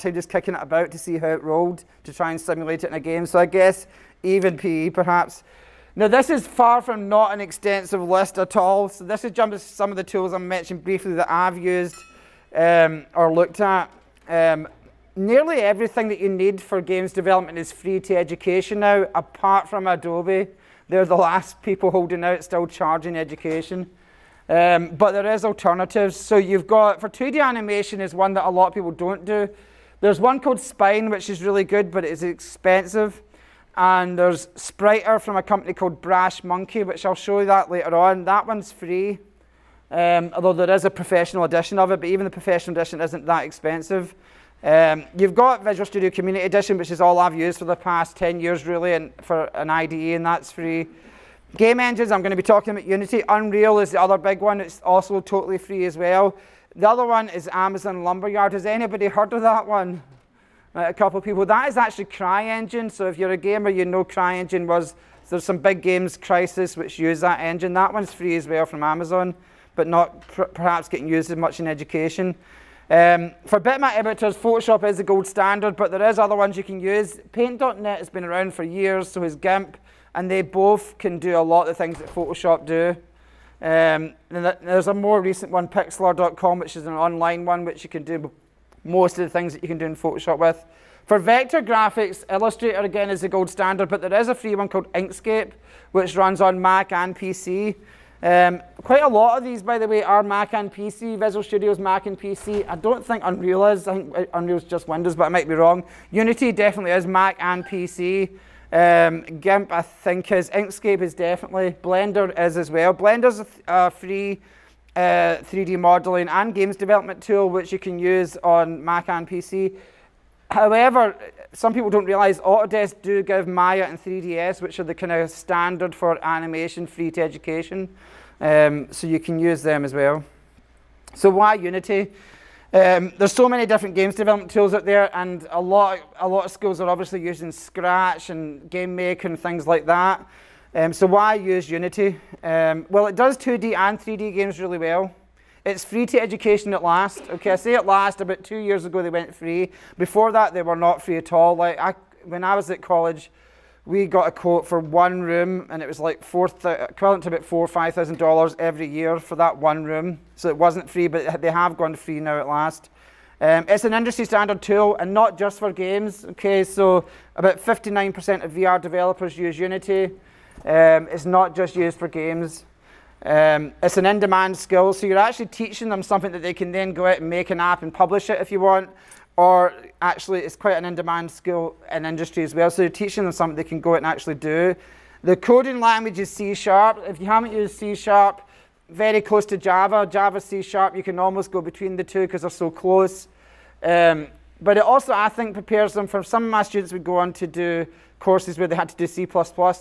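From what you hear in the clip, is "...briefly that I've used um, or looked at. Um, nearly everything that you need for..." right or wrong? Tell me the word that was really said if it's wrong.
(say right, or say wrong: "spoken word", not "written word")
right.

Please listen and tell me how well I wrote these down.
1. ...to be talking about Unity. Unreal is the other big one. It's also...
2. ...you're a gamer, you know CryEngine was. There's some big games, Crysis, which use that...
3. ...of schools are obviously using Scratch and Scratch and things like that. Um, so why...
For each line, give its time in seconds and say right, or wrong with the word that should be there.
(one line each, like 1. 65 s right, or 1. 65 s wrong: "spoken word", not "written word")
1. 52 s right
2. 63 s right
3. 136 s wrong: "Game", not "Scratch".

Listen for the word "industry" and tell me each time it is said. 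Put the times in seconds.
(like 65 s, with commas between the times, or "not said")
163 s, 182 s.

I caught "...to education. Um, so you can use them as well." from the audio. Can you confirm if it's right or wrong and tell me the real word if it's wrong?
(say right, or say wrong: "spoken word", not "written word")
right.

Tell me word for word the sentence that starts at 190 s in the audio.
Java, C Sharp, you can almost go between the two because they're so close.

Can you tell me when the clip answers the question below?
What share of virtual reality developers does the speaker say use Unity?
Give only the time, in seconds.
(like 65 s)
167 s.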